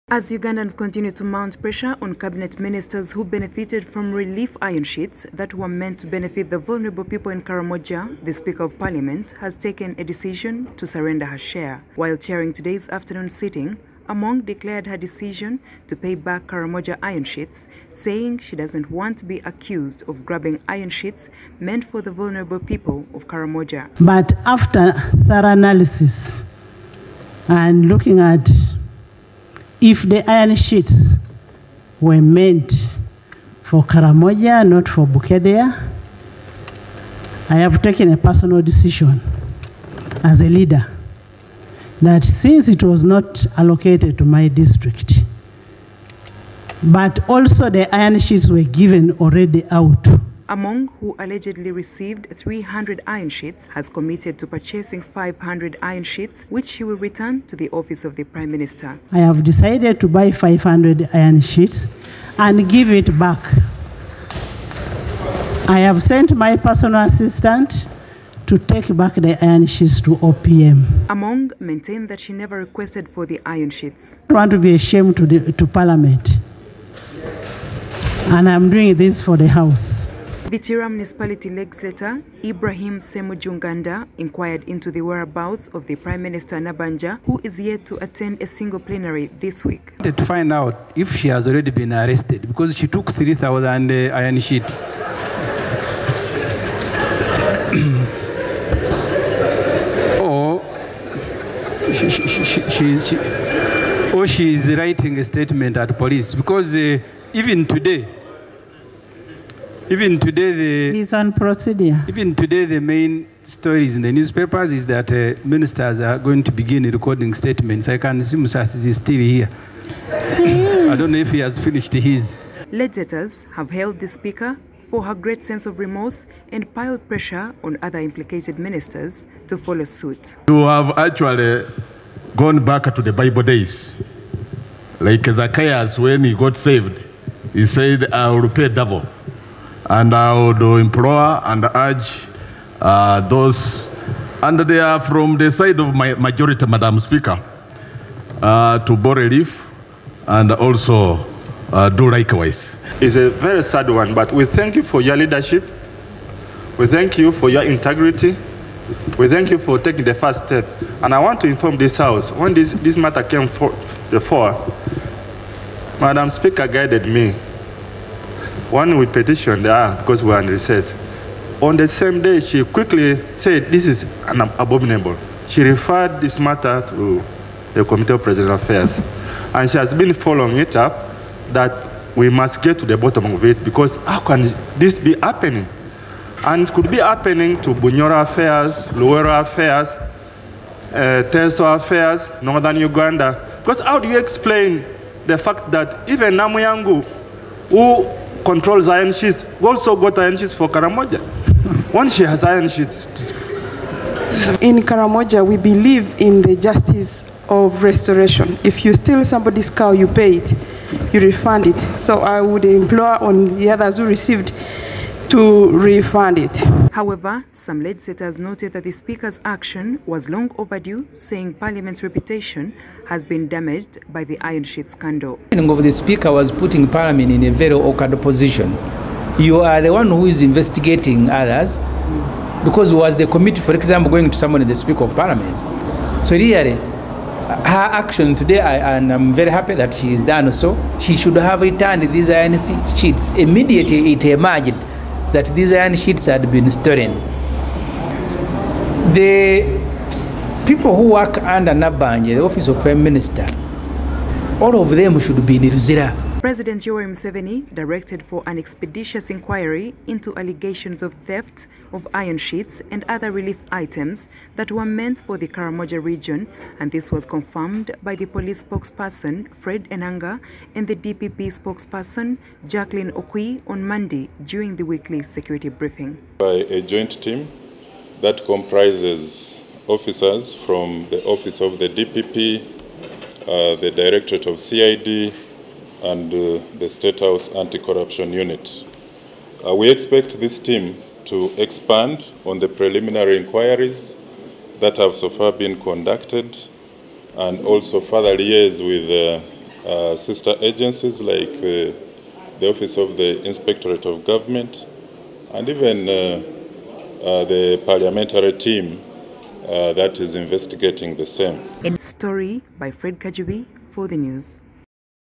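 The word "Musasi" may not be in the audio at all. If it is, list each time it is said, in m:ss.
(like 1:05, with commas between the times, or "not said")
1:58.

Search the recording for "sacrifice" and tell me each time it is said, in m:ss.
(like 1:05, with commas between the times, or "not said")
not said.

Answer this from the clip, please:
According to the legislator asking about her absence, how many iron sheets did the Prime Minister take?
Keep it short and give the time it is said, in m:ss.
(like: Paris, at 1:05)
3,000, at 1:33.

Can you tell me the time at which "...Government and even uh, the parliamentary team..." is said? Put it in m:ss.
5:04.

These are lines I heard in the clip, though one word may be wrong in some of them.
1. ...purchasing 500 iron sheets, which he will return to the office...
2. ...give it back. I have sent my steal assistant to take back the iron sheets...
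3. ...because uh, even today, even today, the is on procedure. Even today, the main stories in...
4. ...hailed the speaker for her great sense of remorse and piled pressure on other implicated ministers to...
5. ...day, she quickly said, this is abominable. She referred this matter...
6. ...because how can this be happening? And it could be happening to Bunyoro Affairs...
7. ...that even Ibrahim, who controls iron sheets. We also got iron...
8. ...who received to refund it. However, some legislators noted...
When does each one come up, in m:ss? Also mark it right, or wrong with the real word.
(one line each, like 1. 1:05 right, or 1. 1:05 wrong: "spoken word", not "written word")
1. 0:54 right
2. 1:02 wrong: "personal", not "steal"
3. 1:46 right
4. 2:03 right
5. 2:52 right
6. 3:03 right
7. 3:15 wrong: "Namuyangu", not "Ibrahim"
8. 3:33 right.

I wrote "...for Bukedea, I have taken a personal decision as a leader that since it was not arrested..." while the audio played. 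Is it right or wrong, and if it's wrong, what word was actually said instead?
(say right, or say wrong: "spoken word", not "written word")
wrong: "allocated", not "arrested".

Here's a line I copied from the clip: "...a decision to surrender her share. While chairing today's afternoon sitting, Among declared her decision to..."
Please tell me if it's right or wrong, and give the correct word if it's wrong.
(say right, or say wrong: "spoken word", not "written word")
right.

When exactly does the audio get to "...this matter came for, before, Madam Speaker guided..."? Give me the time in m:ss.
2:42.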